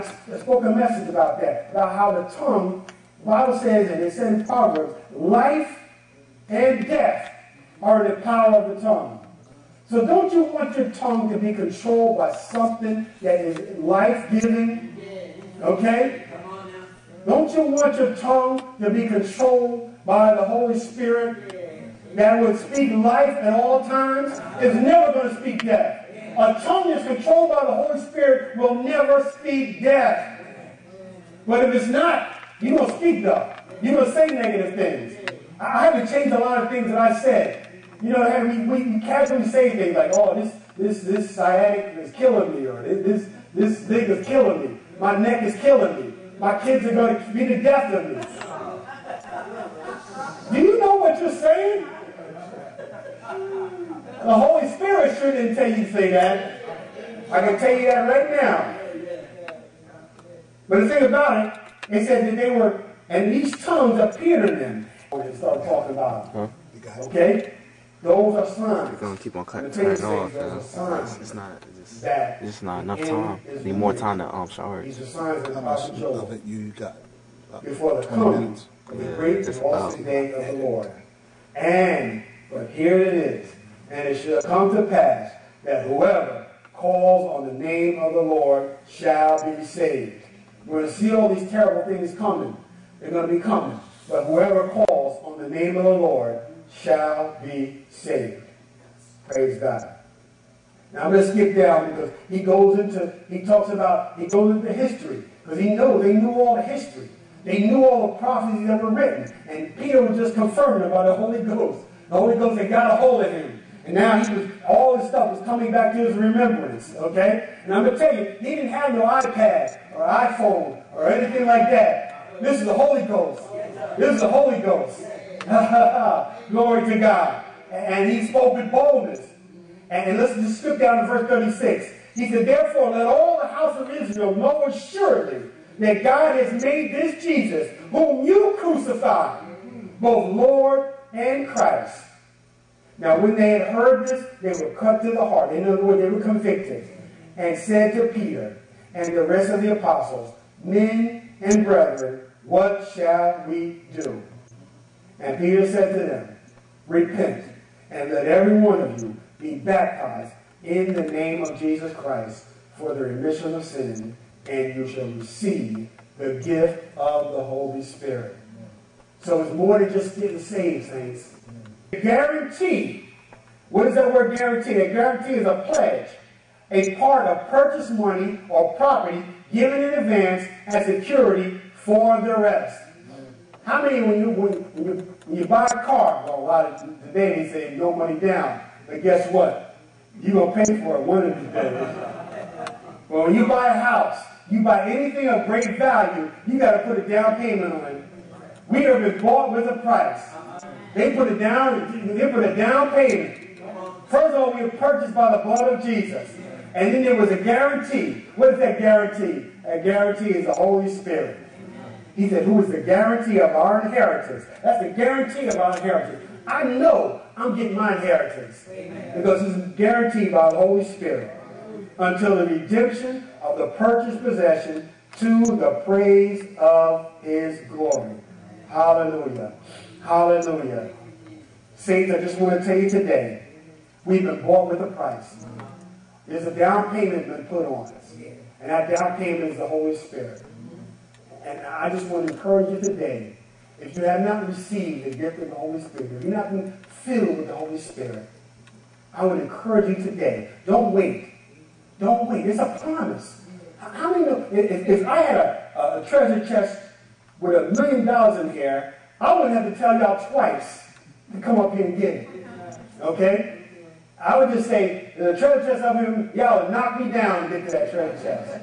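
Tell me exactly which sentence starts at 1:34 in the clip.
But whoever calls on the name of the Lord shall be saved.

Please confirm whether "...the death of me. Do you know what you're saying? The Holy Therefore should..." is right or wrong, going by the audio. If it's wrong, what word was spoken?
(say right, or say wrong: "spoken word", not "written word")
wrong: "Spirit", not "Therefore".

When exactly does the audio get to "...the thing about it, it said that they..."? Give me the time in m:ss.
1:00.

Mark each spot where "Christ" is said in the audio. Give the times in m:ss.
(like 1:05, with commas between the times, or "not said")
2:21, 2:41.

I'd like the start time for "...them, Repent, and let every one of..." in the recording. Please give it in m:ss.
2:35.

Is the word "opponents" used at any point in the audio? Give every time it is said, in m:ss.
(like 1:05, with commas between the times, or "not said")
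not said.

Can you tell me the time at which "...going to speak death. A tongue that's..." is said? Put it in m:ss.
0:25.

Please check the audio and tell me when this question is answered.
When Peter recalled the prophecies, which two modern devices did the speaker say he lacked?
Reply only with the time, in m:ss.
1:59.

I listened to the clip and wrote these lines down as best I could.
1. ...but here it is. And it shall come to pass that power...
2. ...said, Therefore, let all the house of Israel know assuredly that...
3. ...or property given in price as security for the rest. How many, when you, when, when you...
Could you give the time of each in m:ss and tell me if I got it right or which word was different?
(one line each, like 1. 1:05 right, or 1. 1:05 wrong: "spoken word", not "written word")
1. 1:22 wrong: "whoever", not "power"
2. 2:12 right
3. 2:58 wrong: "advance", not "price".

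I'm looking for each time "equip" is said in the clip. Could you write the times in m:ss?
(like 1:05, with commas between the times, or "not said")
not said.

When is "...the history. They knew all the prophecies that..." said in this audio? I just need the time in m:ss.
1:46.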